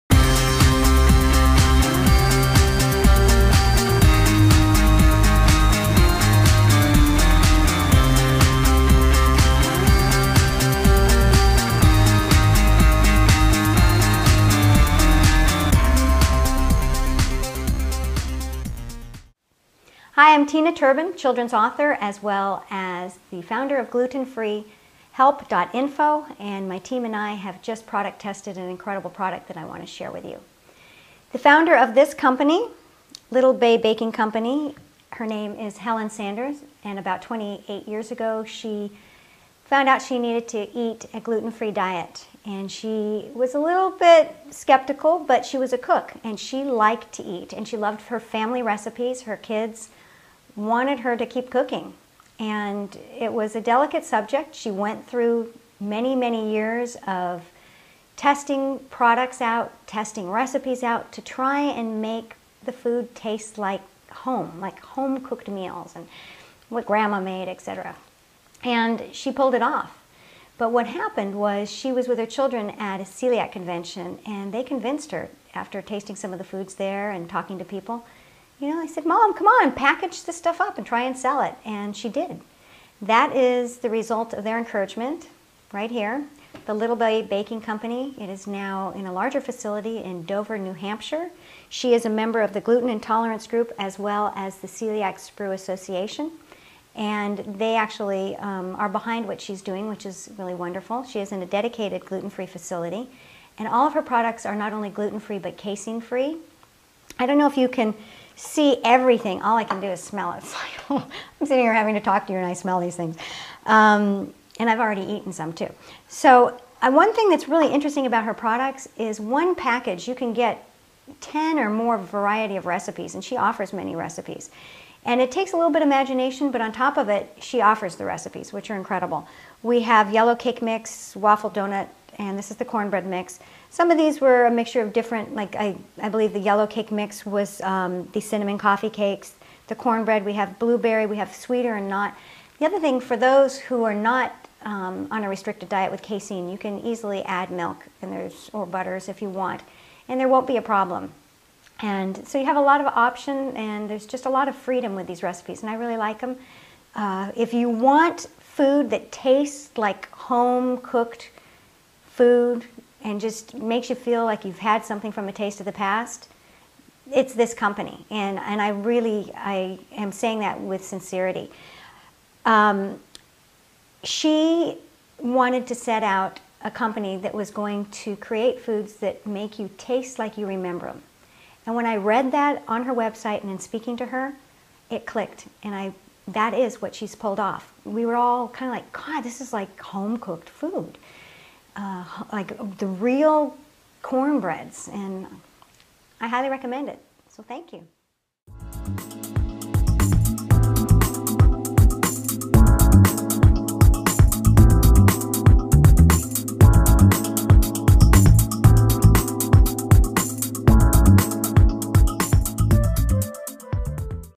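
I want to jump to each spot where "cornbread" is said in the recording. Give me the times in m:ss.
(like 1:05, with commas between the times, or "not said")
2:12, 2:19, 3:14.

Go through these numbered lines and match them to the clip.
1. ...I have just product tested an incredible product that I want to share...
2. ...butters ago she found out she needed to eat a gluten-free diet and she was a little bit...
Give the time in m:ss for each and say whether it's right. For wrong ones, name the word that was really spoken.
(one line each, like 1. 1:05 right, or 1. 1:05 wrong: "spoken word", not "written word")
1. 0:27 right
2. 0:37 wrong: "years", not "butters".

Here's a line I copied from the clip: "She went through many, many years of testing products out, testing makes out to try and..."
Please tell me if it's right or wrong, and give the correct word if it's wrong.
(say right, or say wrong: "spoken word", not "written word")
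wrong: "recipes", not "makes".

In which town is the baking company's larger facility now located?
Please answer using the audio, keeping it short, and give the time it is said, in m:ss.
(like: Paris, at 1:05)
Dover, New Hampshire, at 1:30.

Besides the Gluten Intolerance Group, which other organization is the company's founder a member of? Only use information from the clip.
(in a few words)
Celiac Sprue Association.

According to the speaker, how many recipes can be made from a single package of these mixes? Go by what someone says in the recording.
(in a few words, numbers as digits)
10 or more.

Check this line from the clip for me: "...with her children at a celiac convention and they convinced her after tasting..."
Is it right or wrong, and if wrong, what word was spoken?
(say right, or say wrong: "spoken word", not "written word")
right.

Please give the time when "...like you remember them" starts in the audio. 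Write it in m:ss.
3:00.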